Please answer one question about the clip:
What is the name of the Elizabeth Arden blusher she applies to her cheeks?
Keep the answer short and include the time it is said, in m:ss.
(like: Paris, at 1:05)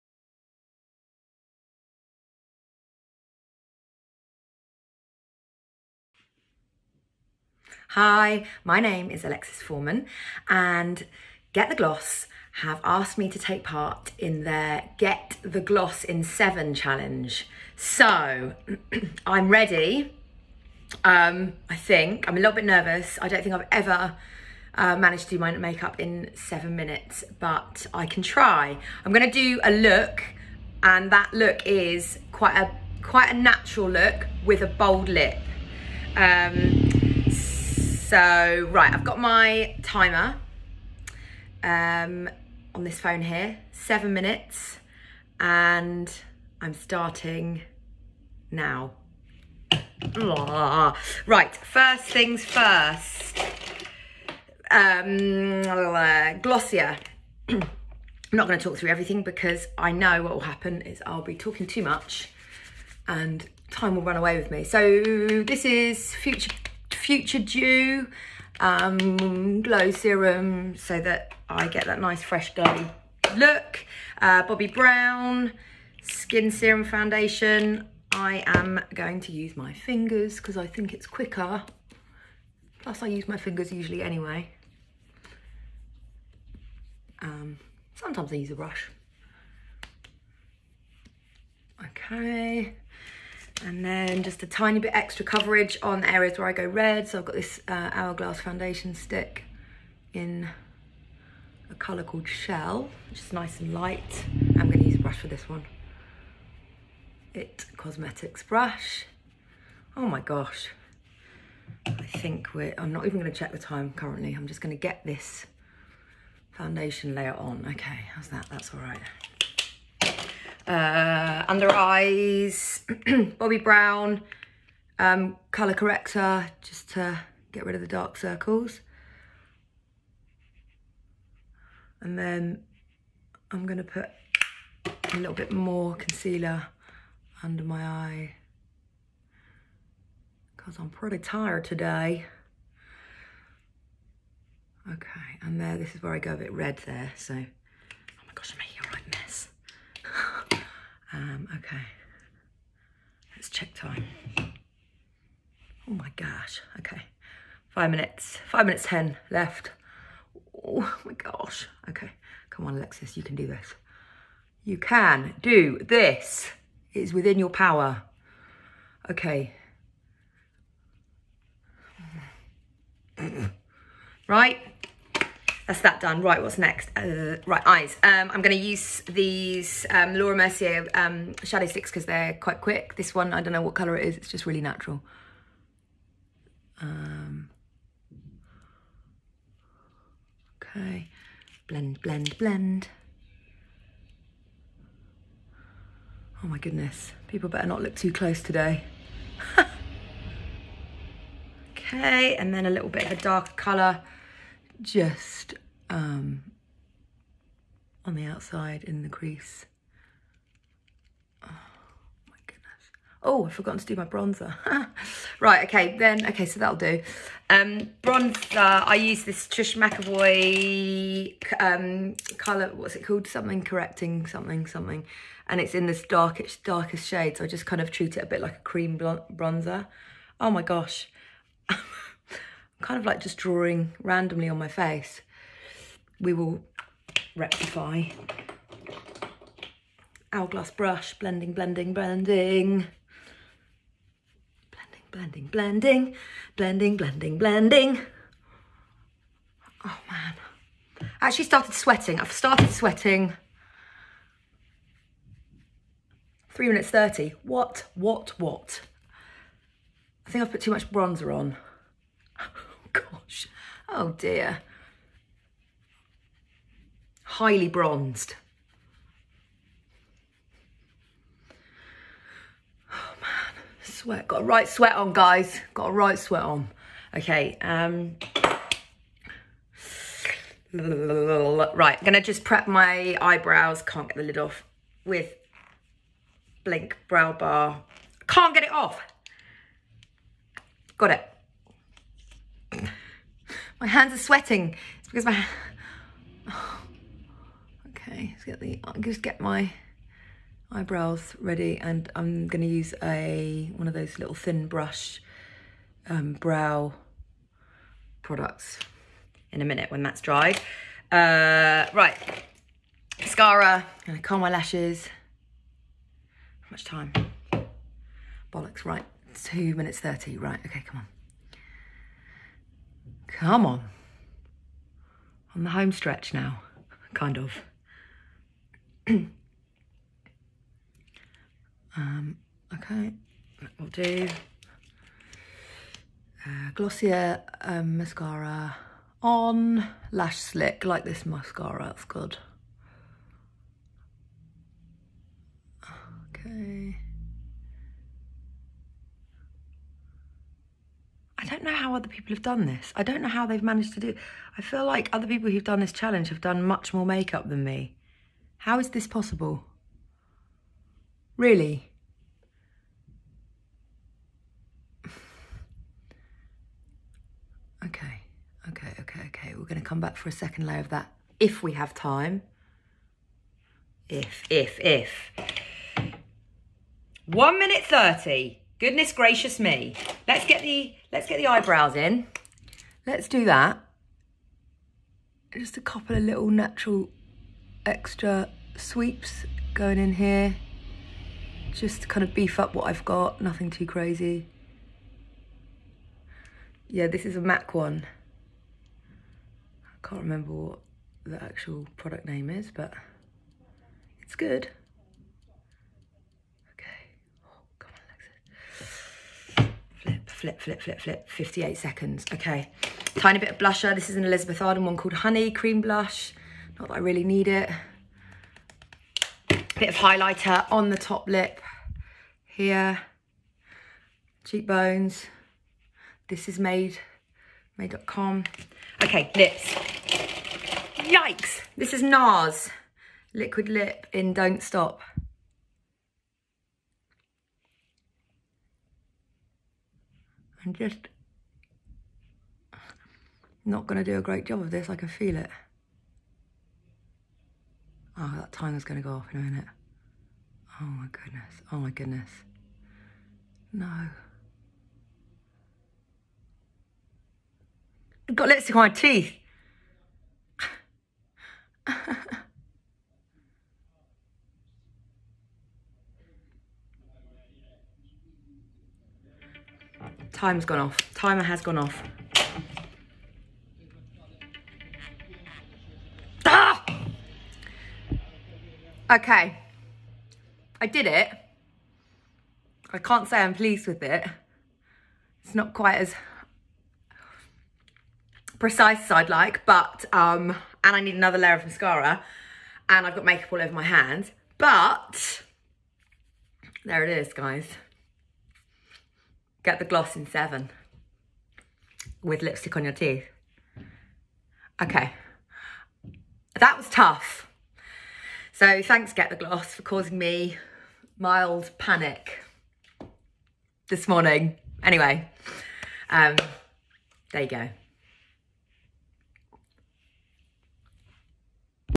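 Honey Cream Blush, at 6:55.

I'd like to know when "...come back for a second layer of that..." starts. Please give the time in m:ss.
6:09.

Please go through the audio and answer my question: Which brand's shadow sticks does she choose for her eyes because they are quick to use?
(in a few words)
Laura Mercier.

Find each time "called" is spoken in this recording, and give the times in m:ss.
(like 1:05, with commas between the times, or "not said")
1:42, 3:43, 6:54.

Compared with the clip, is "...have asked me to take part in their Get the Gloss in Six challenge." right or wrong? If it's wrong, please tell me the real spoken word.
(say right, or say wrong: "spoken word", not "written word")
wrong: "Seven", not "Six".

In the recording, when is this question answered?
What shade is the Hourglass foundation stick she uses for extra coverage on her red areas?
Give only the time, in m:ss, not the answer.
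1:42.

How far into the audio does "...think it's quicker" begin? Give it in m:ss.
1:20.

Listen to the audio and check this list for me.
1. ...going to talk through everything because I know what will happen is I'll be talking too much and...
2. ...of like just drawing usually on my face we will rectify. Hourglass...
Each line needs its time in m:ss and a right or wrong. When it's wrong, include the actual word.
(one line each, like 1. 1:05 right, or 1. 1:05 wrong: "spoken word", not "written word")
1. 0:58 right
2. 3:52 wrong: "randomly", not "usually".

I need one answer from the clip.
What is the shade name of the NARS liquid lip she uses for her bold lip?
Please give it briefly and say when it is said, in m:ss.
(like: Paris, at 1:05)
Don't Stop, at 7:14.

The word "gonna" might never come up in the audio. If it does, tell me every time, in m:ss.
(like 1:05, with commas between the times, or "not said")
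2:13, 4:42, 7:28.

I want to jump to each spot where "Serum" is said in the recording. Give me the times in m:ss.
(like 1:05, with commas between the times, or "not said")
1:09, 1:16.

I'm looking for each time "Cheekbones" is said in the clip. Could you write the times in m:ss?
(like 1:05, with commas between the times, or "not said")
7:04.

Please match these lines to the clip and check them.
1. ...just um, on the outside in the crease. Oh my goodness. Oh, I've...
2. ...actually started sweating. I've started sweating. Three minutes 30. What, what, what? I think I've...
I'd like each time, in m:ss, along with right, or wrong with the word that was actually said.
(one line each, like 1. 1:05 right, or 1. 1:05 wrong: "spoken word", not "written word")
1. 3:24 right
2. 4:11 right.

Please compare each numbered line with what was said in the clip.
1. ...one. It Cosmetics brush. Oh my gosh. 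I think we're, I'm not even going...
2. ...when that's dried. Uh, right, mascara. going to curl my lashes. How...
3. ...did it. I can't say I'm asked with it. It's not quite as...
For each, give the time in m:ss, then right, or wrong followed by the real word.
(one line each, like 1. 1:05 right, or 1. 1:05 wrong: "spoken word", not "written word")
1. 1:45 right
2. 5:09 right
3. 8:00 wrong: "pleased", not "asked".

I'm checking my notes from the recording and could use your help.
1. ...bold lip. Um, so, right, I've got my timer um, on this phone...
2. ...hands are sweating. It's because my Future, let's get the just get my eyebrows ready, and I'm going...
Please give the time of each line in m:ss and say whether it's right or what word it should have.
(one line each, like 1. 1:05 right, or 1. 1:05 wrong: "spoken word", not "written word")
1. 0:34 right
2. 4:53 wrong: "Okay", not "Future".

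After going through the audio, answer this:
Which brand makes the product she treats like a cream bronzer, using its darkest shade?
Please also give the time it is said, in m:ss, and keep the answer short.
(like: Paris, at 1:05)
Trish McEvoy, at 3:39.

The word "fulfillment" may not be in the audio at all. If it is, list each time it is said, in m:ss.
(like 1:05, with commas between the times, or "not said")
not said.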